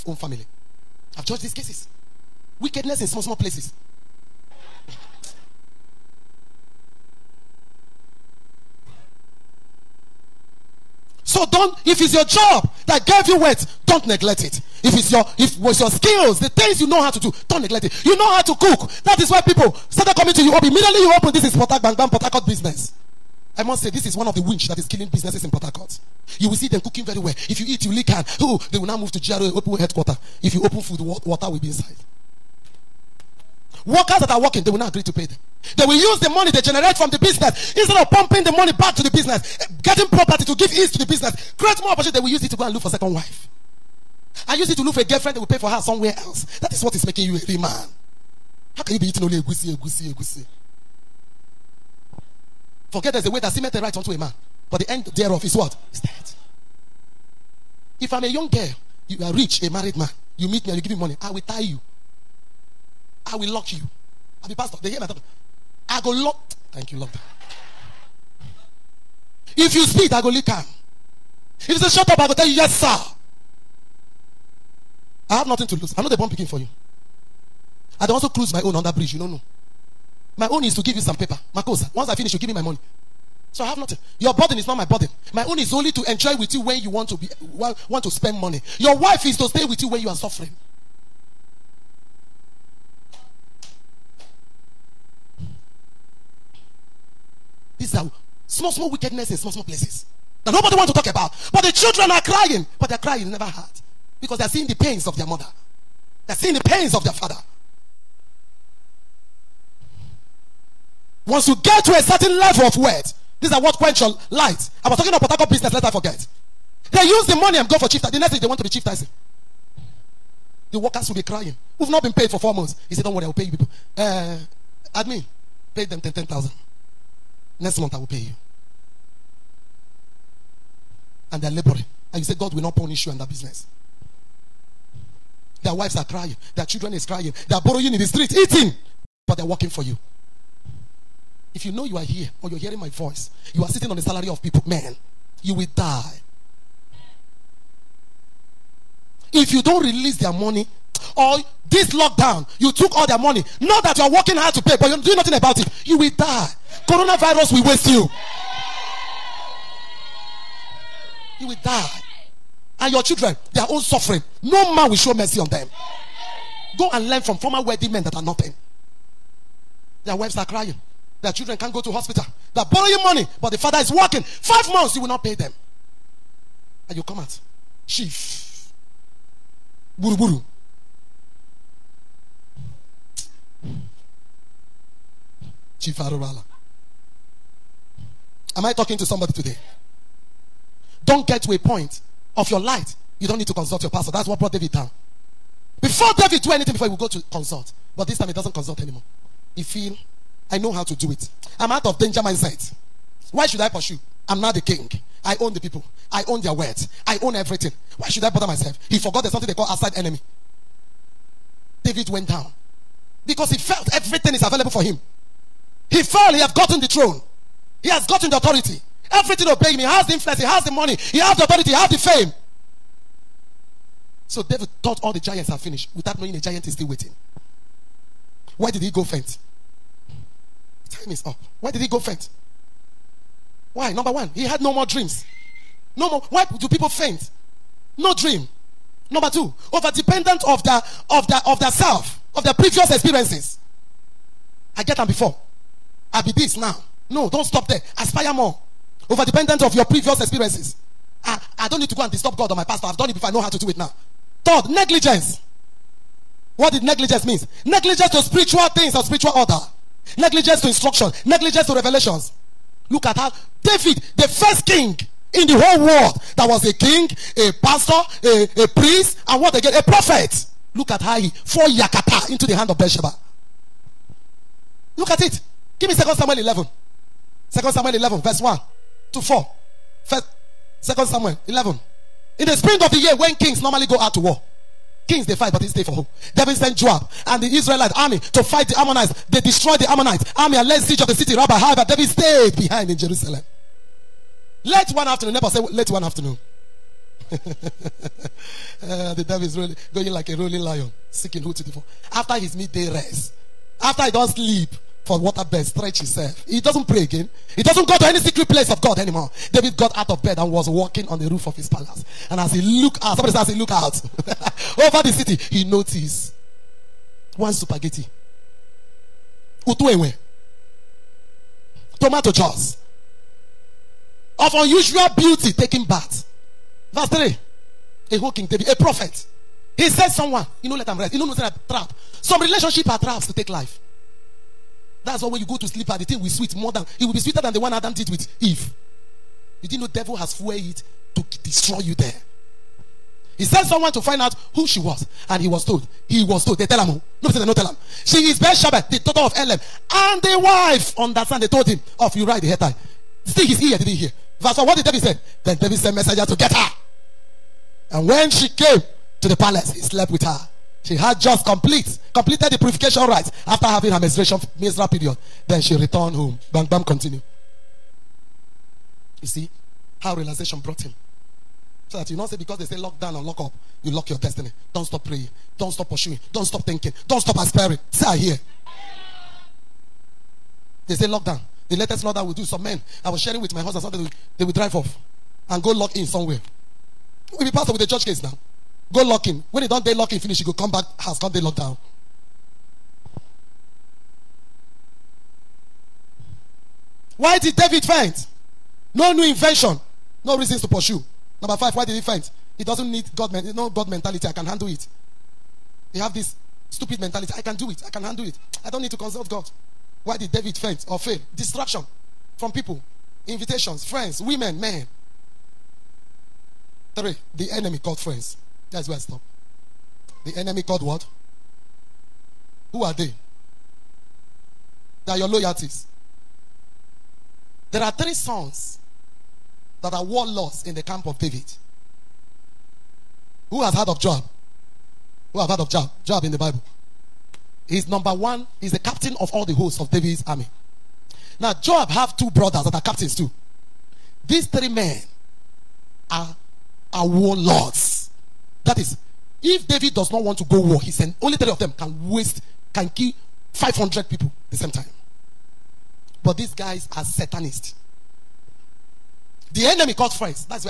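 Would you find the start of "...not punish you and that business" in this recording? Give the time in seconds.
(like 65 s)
132 s.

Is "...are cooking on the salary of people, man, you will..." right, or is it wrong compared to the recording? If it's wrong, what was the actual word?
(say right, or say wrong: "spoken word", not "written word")
wrong: "sitting", not "cooking".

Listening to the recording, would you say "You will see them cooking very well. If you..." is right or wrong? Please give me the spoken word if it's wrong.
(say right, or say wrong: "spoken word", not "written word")
right.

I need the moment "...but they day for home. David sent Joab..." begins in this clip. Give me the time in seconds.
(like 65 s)
285 s.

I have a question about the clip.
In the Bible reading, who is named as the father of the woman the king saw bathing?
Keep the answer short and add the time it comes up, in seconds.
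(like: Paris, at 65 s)
Elam, at 349 s.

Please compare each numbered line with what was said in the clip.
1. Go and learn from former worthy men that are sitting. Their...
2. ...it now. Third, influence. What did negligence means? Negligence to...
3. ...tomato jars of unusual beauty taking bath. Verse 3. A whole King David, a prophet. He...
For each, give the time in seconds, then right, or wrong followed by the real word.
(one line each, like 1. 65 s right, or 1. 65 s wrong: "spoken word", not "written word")
1. 166 s wrong: "nothing", not "sitting"
2. 253 s wrong: "negligence", not "influence"
3. 322 s right.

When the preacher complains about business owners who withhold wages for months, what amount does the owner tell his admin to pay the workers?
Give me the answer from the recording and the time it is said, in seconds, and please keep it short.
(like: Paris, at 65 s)
10,000, at 126 s.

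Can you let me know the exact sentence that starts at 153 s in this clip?
Not that you are working hard to pay, but you're doing nothing about it.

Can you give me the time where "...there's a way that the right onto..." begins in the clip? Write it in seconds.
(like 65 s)
53 s.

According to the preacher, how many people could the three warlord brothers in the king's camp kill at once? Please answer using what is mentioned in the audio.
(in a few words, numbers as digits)
500.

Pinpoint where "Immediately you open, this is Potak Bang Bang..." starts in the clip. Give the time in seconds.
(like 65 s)
20 s.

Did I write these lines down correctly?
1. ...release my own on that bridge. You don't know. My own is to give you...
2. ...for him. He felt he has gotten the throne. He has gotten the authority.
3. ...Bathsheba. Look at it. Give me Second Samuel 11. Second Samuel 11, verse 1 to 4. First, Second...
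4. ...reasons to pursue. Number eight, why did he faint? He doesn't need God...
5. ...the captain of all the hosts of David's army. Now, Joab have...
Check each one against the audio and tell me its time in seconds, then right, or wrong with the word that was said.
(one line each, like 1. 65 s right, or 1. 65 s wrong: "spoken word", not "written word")
1. 78 s wrong: "cruise", not "release"
2. 214 s right
3. 272 s right
4. 400 s wrong: "five", not "eight"
5. 438 s right.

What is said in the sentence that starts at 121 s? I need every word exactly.
We've not been paid for four months.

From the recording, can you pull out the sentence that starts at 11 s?
So don't, if it's your job that gave you wealth, don't neglect it.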